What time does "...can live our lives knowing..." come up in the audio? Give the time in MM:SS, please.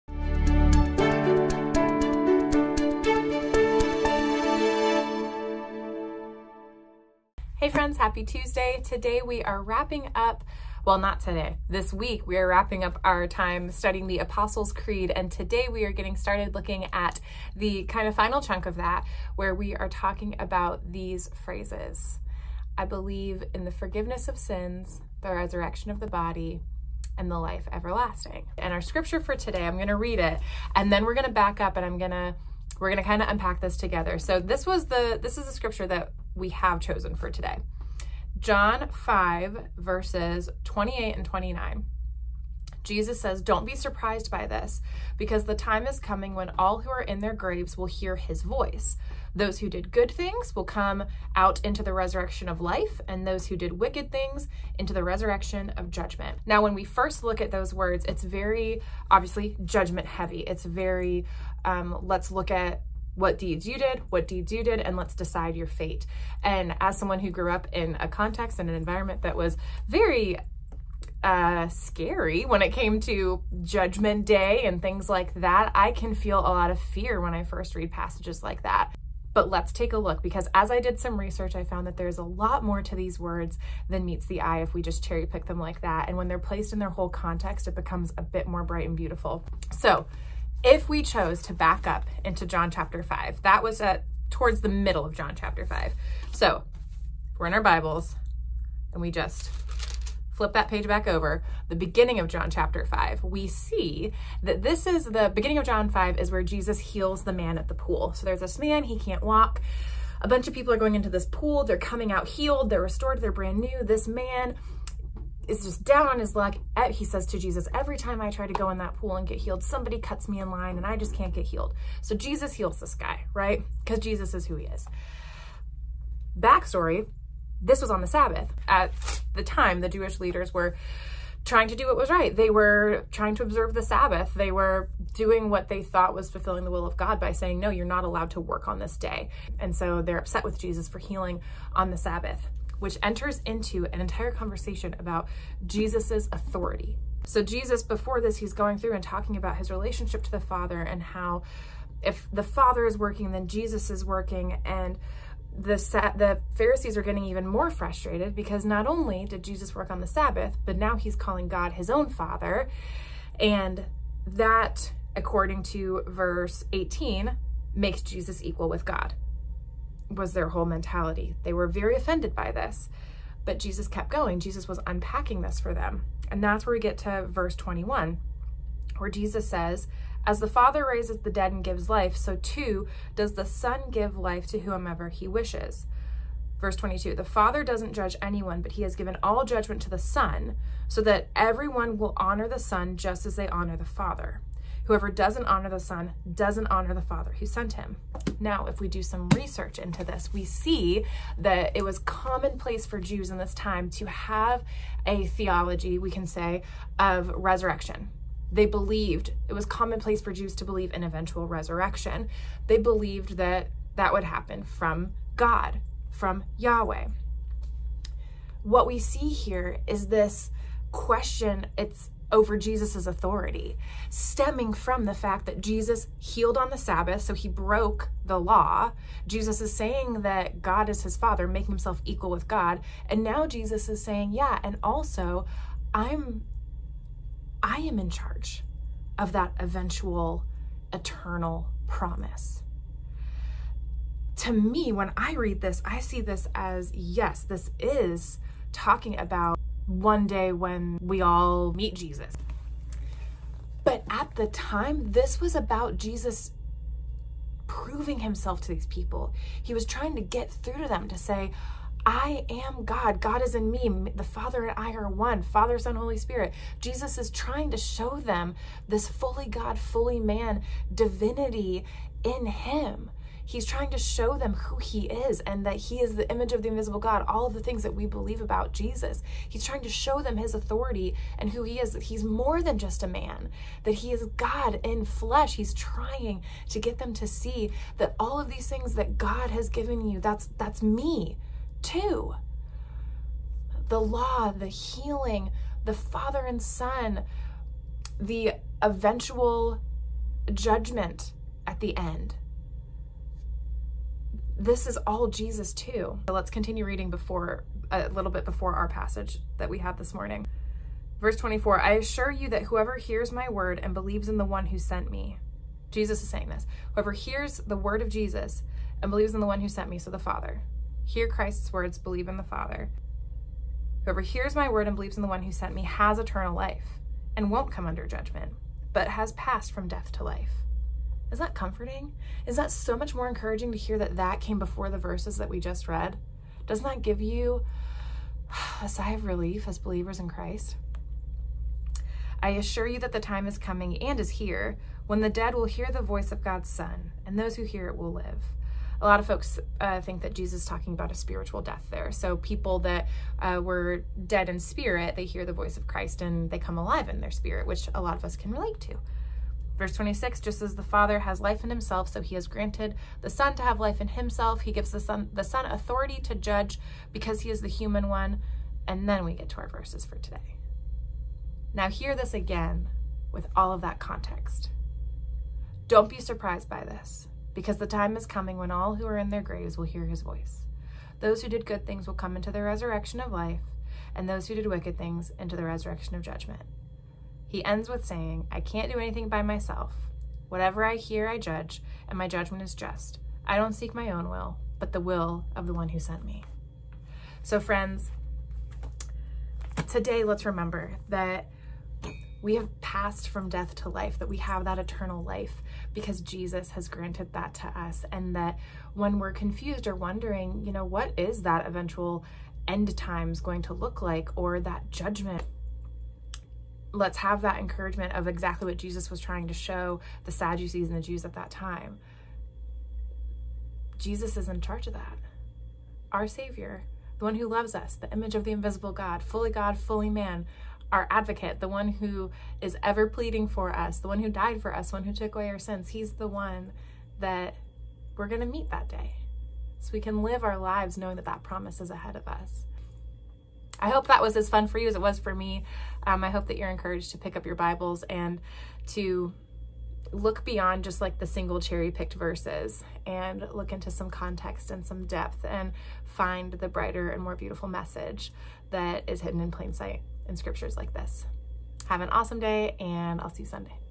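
07:20.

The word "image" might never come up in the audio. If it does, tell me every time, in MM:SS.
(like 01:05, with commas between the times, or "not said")
04:36, 07:08.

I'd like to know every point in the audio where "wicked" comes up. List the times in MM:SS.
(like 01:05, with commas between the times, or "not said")
00:53, 06:24.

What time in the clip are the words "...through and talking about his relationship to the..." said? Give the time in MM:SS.
02:28.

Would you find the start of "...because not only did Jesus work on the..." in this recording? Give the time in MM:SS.
02:38.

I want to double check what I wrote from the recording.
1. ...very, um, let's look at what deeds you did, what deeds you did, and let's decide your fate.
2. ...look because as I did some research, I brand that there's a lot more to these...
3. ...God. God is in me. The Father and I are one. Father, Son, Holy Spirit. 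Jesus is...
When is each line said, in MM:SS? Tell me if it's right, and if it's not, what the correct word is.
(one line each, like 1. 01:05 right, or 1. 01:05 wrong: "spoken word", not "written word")
1. 01:00 right
2. 01:19 wrong: "found", not "brand"
3. 04:22 right.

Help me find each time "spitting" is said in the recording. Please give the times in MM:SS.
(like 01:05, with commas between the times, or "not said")
not said.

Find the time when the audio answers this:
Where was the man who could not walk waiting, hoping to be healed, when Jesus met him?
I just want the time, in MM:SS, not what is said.
01:47.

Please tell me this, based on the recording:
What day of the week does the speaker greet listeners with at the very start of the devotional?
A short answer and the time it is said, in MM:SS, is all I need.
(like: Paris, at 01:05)
Tuesday, at 00:08.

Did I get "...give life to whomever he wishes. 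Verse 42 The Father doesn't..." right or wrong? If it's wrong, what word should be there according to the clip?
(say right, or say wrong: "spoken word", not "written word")
wrong: "22", not "42".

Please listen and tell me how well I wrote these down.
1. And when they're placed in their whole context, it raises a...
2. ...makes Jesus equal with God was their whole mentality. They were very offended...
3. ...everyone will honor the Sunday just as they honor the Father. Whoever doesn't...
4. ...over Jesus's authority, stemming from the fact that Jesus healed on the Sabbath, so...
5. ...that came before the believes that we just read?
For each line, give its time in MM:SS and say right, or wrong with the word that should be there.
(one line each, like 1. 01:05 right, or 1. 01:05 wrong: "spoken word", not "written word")
1. 01:26 wrong: "becomes", not "raises"
2. 02:47 right
3. 03:11 wrong: "Son", not "Sunday"
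4. 03:42 right
5. 05:34 wrong: "verses", not "believes".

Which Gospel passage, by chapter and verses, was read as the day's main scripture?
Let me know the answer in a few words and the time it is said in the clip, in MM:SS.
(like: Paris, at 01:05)
John 5:28-29, at 00:38.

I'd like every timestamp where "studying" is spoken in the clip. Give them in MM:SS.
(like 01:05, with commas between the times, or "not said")
00:13.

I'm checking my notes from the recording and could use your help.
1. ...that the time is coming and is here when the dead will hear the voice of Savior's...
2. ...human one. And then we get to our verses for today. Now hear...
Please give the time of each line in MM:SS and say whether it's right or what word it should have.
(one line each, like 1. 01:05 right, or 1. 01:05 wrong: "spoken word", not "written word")
1. 05:42 wrong: "God", not "Savior"
2. 06:07 right.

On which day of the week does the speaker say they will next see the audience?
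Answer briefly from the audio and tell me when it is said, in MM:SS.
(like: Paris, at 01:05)
Sunday, at 07:43.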